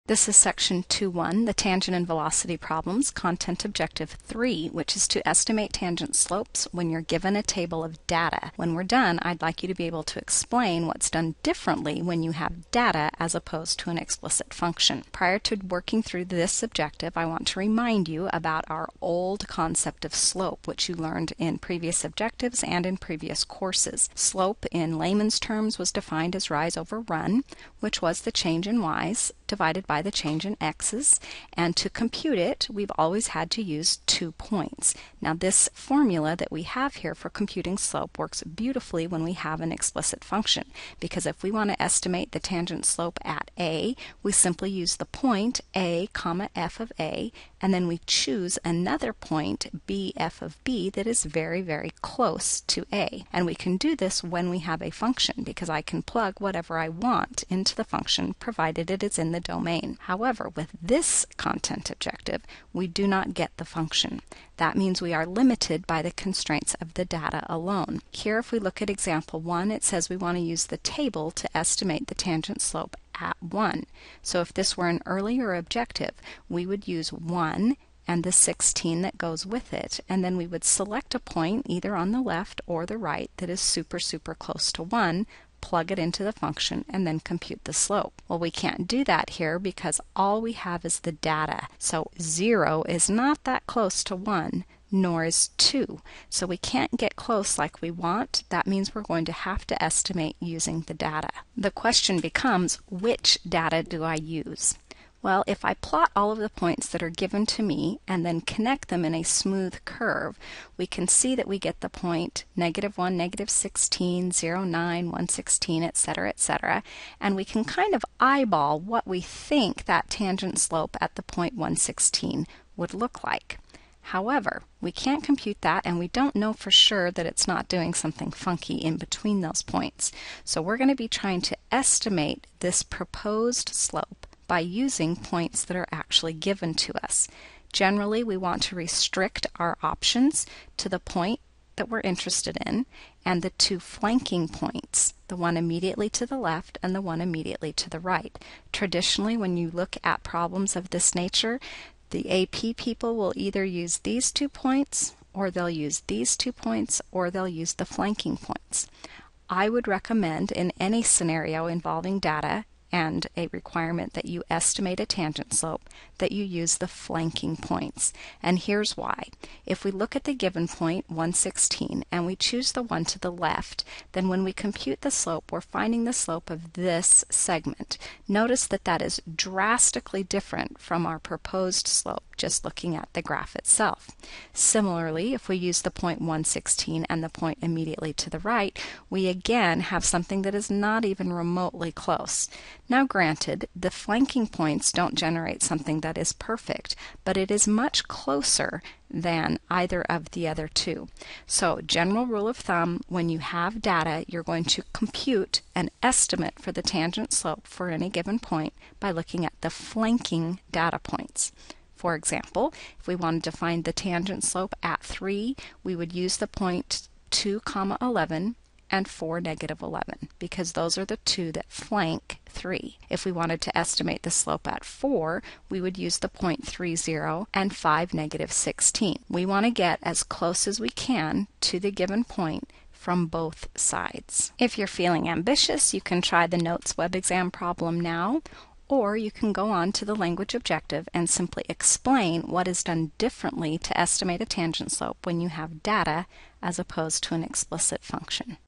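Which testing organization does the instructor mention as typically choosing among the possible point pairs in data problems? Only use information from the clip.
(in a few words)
AP.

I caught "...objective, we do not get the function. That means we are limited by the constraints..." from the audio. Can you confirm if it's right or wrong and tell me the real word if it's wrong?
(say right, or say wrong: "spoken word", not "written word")
right.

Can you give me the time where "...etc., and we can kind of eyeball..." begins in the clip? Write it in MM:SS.
01:56.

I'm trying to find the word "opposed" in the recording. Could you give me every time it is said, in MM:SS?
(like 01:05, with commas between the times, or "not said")
00:13, 04:06.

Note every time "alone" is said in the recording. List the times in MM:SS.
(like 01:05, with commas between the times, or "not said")
01:07.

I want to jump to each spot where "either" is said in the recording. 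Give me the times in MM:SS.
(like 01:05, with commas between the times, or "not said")
01:21, 02:33, 03:19.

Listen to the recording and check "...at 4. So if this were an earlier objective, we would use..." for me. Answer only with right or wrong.
wrong.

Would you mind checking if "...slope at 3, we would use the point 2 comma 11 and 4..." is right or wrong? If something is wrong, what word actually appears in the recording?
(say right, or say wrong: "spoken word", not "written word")
right.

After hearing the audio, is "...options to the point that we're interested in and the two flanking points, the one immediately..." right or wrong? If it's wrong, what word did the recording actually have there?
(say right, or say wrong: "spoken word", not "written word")
right.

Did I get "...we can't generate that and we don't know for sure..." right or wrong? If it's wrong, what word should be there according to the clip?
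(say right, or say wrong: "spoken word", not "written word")
wrong: "compute", not "generate".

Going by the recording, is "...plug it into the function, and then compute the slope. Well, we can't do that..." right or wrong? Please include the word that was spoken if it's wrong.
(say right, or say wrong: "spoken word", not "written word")
right.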